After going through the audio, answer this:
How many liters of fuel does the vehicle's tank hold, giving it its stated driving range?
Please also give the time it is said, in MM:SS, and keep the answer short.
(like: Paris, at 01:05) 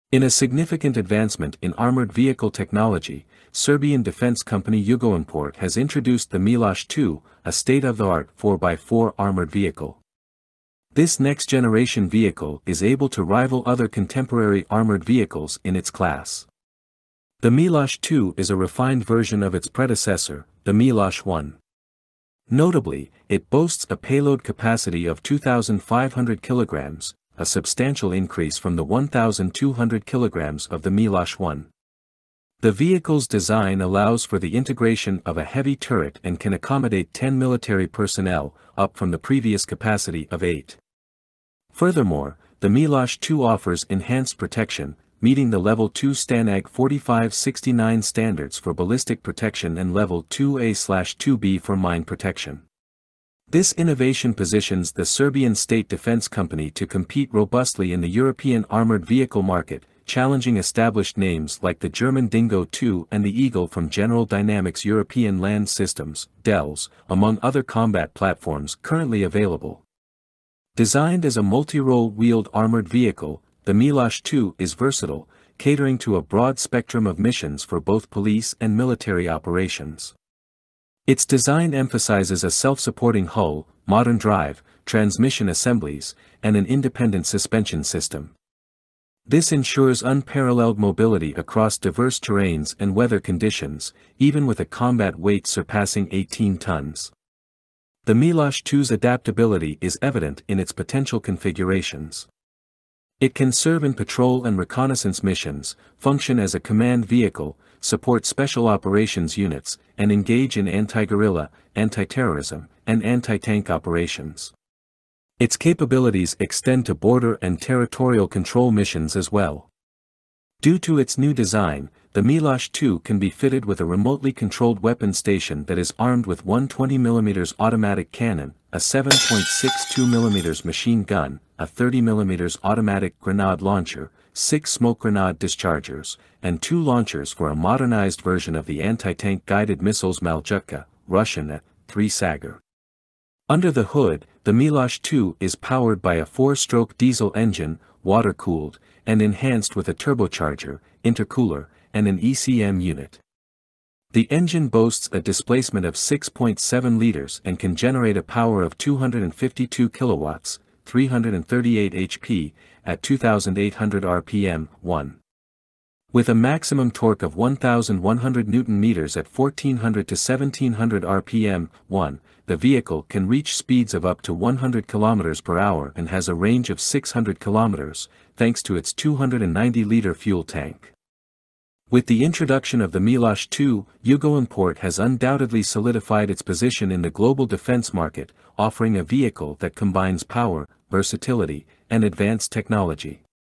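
290 liters, at 02:58.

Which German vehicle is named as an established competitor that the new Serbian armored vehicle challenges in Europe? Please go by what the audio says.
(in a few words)
Dingo II.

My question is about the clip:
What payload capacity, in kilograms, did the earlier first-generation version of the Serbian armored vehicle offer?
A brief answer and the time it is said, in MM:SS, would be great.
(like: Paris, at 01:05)
1,200 kilograms, at 00:28.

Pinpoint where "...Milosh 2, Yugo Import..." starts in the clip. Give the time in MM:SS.
03:03.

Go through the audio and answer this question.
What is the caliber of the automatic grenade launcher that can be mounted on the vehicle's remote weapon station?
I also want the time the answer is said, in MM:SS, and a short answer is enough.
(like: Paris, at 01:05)
30mm, at 02:11.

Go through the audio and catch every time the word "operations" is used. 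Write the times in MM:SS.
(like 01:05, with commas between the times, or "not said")
01:19, 01:48, 01:53.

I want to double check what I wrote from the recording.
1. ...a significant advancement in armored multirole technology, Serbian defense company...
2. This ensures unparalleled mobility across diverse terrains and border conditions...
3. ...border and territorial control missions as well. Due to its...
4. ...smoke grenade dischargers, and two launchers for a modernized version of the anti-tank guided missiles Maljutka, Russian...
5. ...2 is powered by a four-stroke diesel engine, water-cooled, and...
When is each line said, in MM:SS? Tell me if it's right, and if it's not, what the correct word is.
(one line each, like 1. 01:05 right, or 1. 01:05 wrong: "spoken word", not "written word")
1. 00:00 wrong: "vehicle", not "multirole"
2. 01:29 wrong: "weather", not "border"
3. 01:56 right
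4. 02:14 right
5. 02:25 right.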